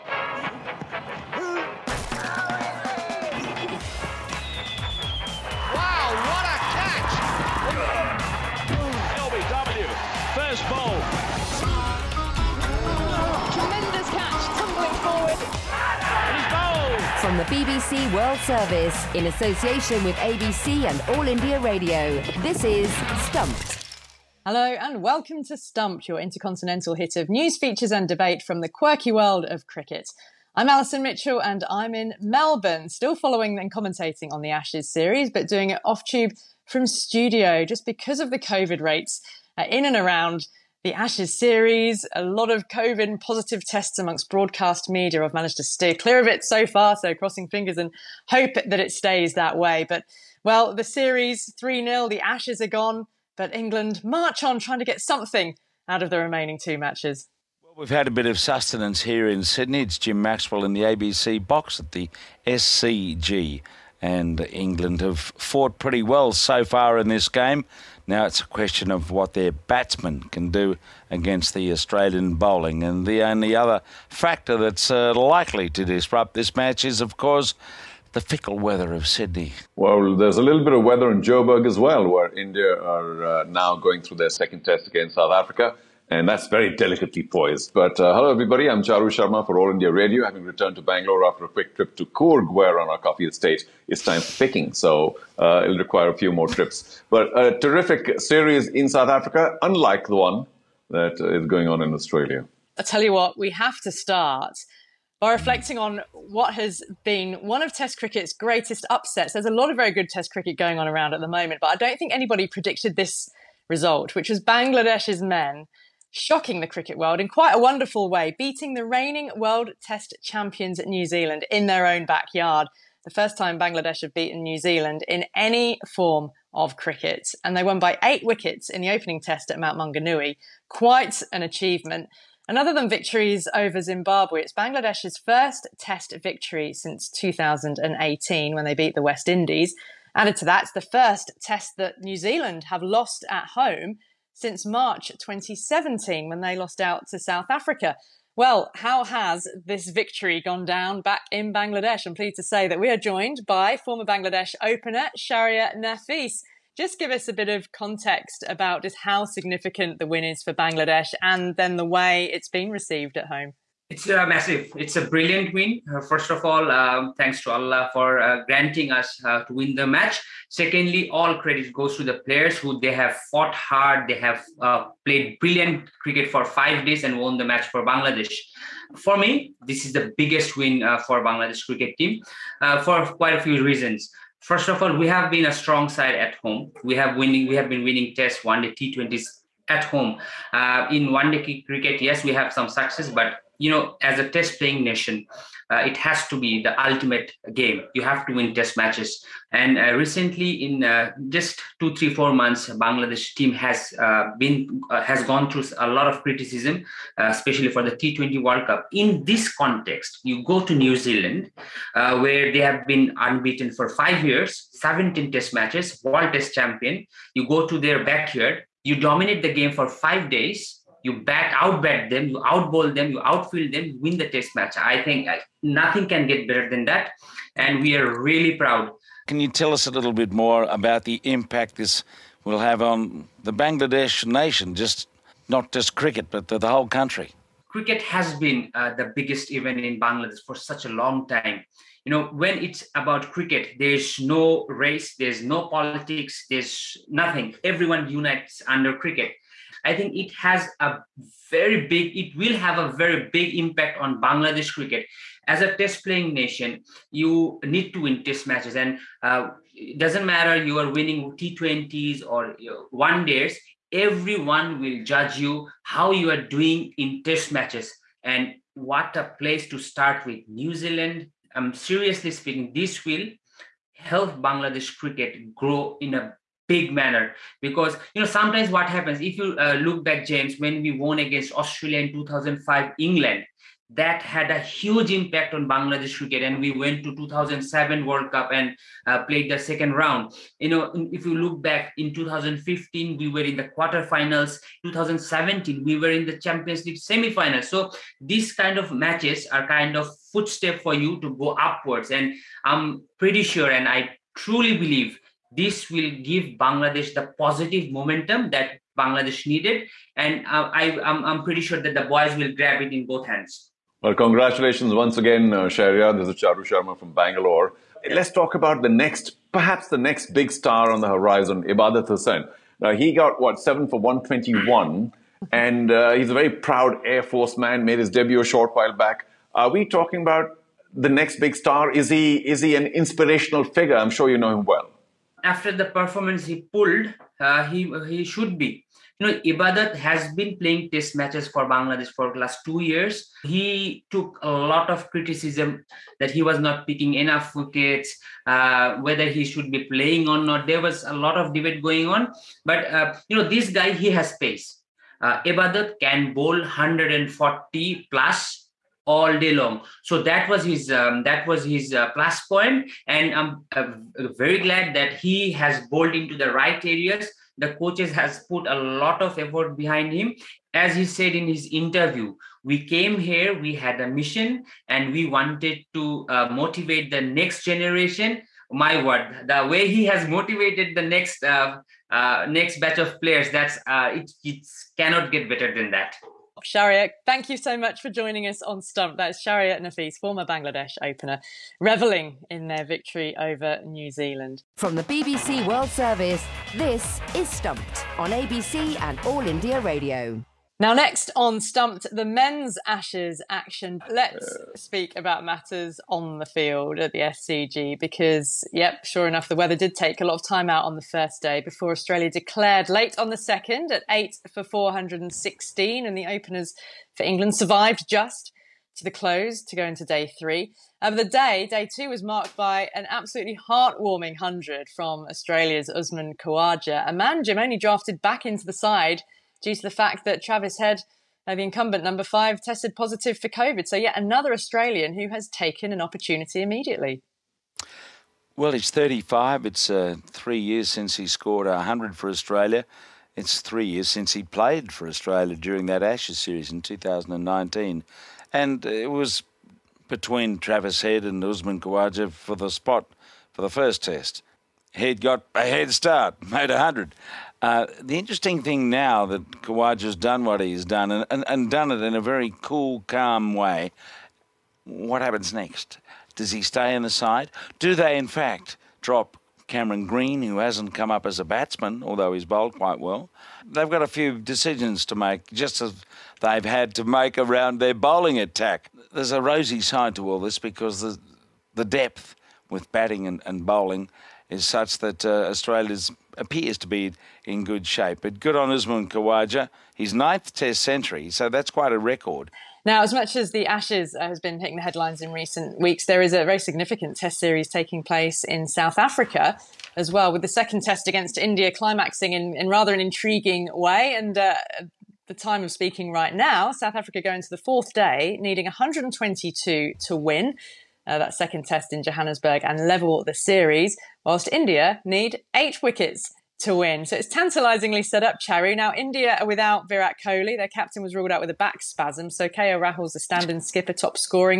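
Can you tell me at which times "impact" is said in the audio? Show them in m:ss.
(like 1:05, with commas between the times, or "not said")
3:51, 4:13, 4:45.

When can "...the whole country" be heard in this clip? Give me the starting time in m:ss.
3:56.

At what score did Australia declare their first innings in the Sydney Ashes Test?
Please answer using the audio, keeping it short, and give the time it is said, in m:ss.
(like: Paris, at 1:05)
8 for 416, at 6:54.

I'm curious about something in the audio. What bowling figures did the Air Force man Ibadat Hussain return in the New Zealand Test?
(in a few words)
7 for 121.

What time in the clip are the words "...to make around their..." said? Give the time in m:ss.
7:56.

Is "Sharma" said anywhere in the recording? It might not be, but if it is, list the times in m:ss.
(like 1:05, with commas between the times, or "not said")
1:29, 5:16.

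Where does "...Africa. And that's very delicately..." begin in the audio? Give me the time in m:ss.
1:25.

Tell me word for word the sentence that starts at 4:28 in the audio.
And what a place to start with.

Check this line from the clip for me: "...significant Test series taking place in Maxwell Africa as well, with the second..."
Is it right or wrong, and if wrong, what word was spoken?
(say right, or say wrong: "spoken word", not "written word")
wrong: "South", not "Maxwell".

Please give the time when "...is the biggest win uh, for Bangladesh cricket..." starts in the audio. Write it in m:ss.
2:59.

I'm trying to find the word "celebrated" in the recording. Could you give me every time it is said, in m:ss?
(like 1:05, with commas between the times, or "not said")
not said.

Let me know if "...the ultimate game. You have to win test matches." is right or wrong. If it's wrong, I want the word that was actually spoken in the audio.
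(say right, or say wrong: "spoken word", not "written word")
right.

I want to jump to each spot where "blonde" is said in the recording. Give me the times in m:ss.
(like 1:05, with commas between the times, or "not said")
not said.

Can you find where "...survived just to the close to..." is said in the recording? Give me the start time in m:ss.
6:57.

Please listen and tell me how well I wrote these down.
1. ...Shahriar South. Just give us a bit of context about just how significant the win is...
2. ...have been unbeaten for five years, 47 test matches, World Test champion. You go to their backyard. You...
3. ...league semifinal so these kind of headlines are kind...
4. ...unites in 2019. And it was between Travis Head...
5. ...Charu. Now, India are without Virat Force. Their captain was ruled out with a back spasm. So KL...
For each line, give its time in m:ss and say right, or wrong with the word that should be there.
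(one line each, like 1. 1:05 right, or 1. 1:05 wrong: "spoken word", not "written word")
1. 2:35 wrong: "Nafees", not "South"
2. 3:32 wrong: "17", not "47"
3. 4:56 wrong: "matches", not "headlines"
4. 7:26 wrong: "series", not "unites"
5. 8:38 wrong: "Kohli", not "Force".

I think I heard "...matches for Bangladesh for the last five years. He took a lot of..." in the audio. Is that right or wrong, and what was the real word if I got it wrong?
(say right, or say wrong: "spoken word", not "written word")
wrong: "two", not "five".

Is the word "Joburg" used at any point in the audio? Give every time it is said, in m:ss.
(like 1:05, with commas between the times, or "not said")
1:21.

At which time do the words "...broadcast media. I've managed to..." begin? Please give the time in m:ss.
0:44.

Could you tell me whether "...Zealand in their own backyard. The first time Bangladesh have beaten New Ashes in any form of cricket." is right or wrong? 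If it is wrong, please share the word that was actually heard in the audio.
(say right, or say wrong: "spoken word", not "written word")
wrong: "Zealand", not "Ashes".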